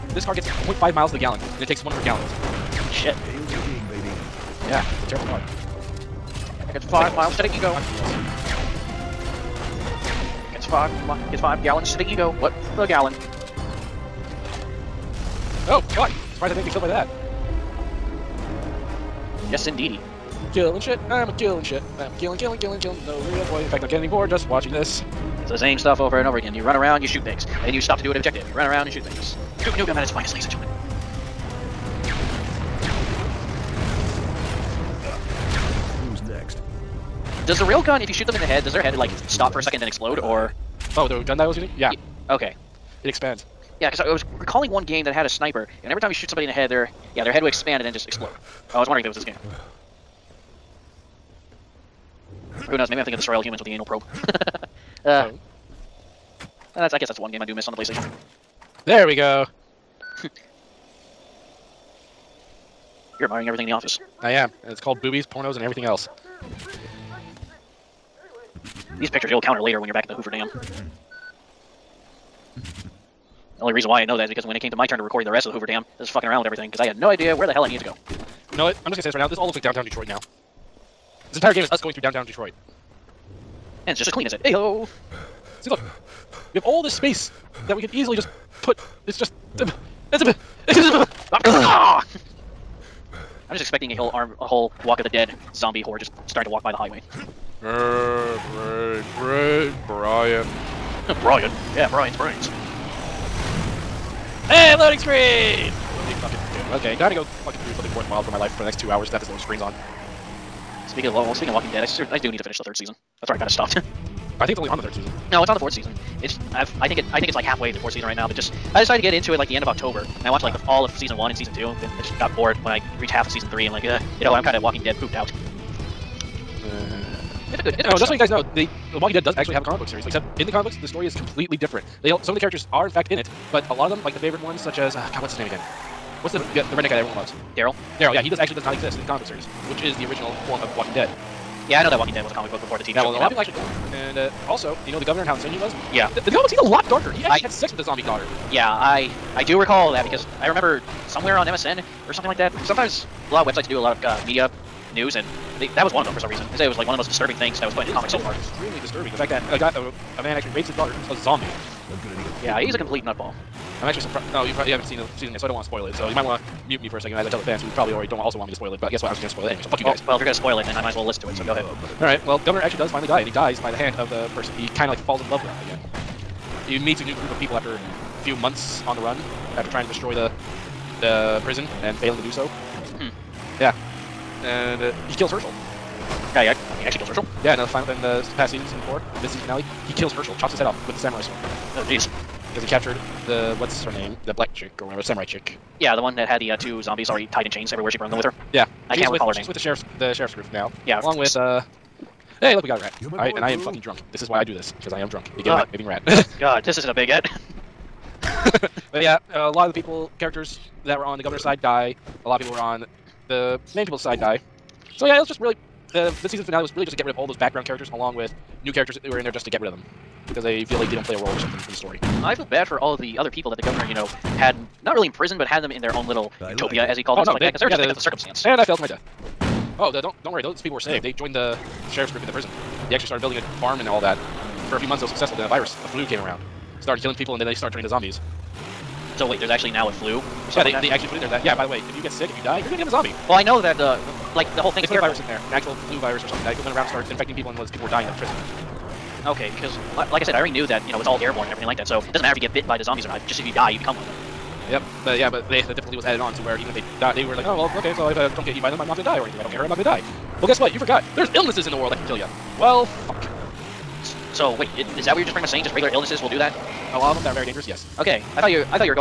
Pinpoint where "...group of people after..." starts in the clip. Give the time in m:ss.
2:57.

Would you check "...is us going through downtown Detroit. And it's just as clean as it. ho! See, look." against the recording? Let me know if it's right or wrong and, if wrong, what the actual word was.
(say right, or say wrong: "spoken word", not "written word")
right.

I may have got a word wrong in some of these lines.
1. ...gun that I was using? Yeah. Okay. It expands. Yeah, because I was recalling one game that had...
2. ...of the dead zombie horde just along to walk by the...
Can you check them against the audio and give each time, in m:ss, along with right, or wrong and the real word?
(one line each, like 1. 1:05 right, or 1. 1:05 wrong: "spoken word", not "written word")
1. 0:41 right
2. 1:34 wrong: "starting", not "along".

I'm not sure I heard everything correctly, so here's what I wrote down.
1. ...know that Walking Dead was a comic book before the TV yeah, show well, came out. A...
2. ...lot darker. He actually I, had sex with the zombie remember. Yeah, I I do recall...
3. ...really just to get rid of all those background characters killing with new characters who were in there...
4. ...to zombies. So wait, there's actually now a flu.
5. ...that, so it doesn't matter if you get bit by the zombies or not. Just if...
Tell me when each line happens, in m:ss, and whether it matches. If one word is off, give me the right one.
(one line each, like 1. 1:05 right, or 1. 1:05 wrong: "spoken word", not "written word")
1. 2:21 right
2. 2:26 wrong: "daughter", not "remember"
3. 3:36 wrong: "along", not "killing"
4. 3:57 right
5. 4:11 right.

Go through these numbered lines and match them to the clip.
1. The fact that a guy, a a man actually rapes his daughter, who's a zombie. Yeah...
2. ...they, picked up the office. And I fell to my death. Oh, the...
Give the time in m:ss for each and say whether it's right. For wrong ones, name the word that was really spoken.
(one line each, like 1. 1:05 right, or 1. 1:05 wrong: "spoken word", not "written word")
1. 2:39 right
2. 3:47 wrong: "circumstance", not "office".